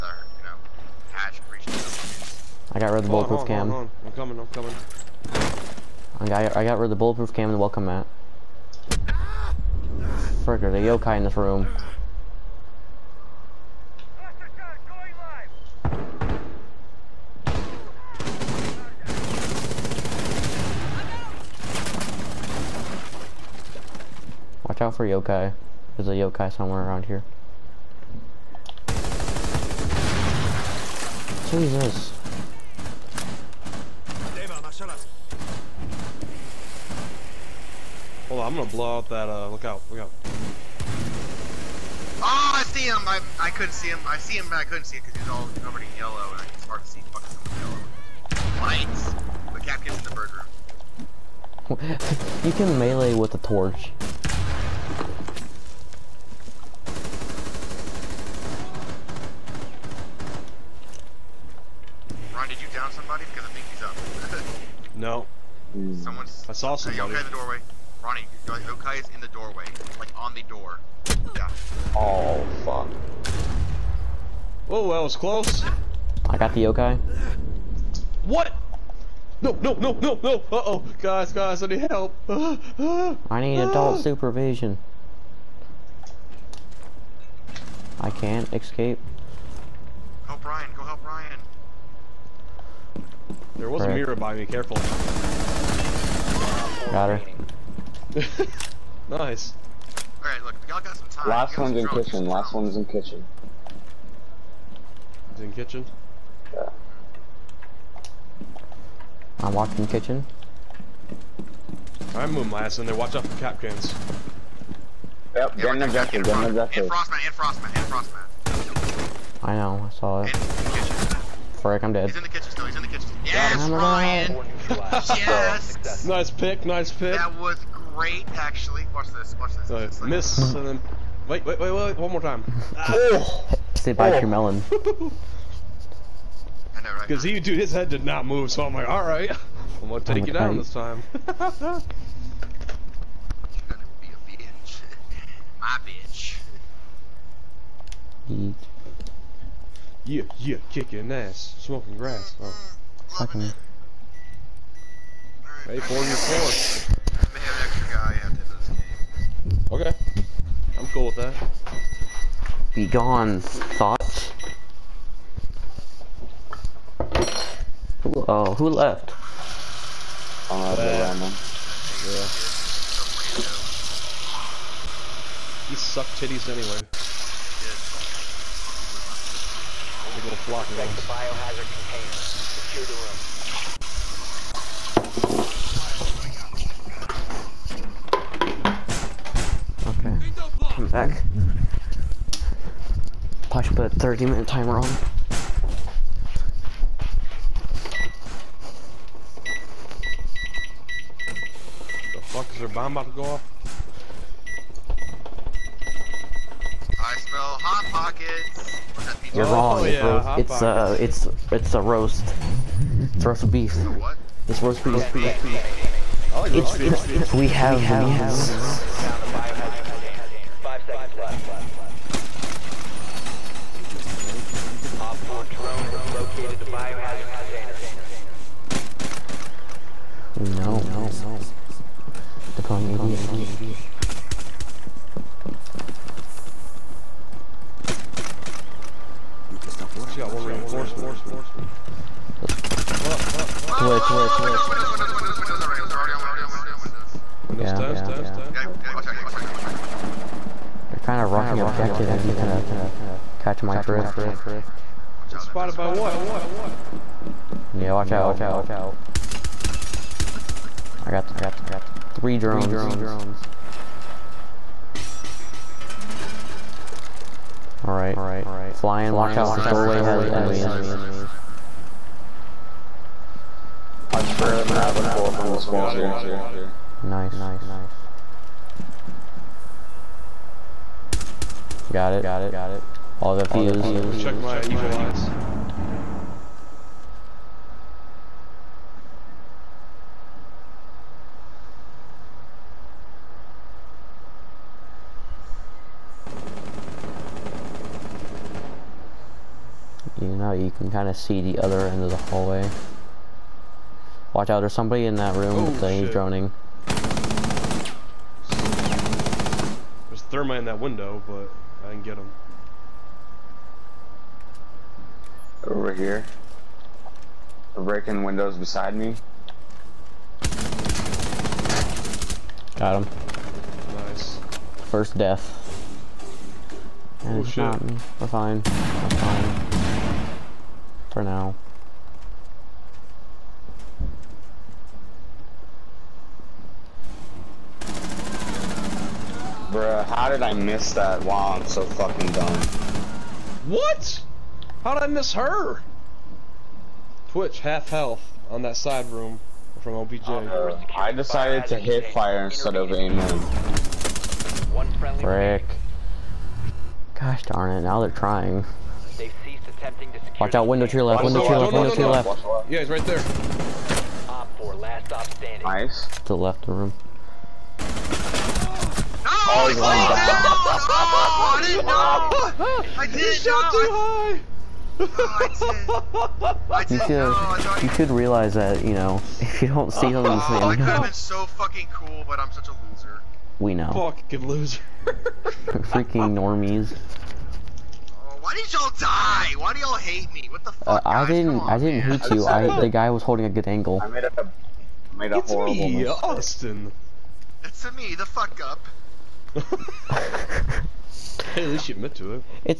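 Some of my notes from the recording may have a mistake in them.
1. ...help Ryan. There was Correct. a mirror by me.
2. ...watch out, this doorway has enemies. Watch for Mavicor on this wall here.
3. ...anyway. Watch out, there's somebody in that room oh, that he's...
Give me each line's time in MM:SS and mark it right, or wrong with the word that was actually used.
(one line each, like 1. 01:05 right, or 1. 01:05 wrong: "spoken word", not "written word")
1. 01:30 right
2. 04:29 right
3. 05:02 wrong: "hallway", not "anyway".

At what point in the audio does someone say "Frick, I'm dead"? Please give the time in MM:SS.
02:01.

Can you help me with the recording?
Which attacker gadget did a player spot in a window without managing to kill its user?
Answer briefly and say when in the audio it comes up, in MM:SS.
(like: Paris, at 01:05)
thermite, at 05:10.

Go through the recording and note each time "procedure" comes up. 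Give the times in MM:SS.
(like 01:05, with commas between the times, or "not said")
not said.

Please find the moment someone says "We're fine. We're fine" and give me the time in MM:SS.
05:28.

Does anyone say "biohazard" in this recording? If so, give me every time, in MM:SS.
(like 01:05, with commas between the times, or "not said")
03:01, 03:46.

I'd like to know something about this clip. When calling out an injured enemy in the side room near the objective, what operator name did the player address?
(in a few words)
Twitch.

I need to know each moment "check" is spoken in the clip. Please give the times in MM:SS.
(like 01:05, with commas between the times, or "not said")
03:00, 04:44.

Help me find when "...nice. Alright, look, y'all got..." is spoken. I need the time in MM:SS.
01:39.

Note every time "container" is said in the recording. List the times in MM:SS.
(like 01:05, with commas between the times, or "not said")
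03:01, 03:47.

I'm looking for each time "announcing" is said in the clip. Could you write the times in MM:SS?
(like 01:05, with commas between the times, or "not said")
not said.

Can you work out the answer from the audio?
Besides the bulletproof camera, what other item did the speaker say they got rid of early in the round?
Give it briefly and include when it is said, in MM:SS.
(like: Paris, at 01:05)
welcome mat, at 00:07.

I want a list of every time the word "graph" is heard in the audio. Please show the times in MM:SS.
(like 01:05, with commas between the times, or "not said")
not said.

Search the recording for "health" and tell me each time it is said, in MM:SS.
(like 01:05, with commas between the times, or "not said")
05:47.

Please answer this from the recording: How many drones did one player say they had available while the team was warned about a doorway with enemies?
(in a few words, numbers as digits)
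3.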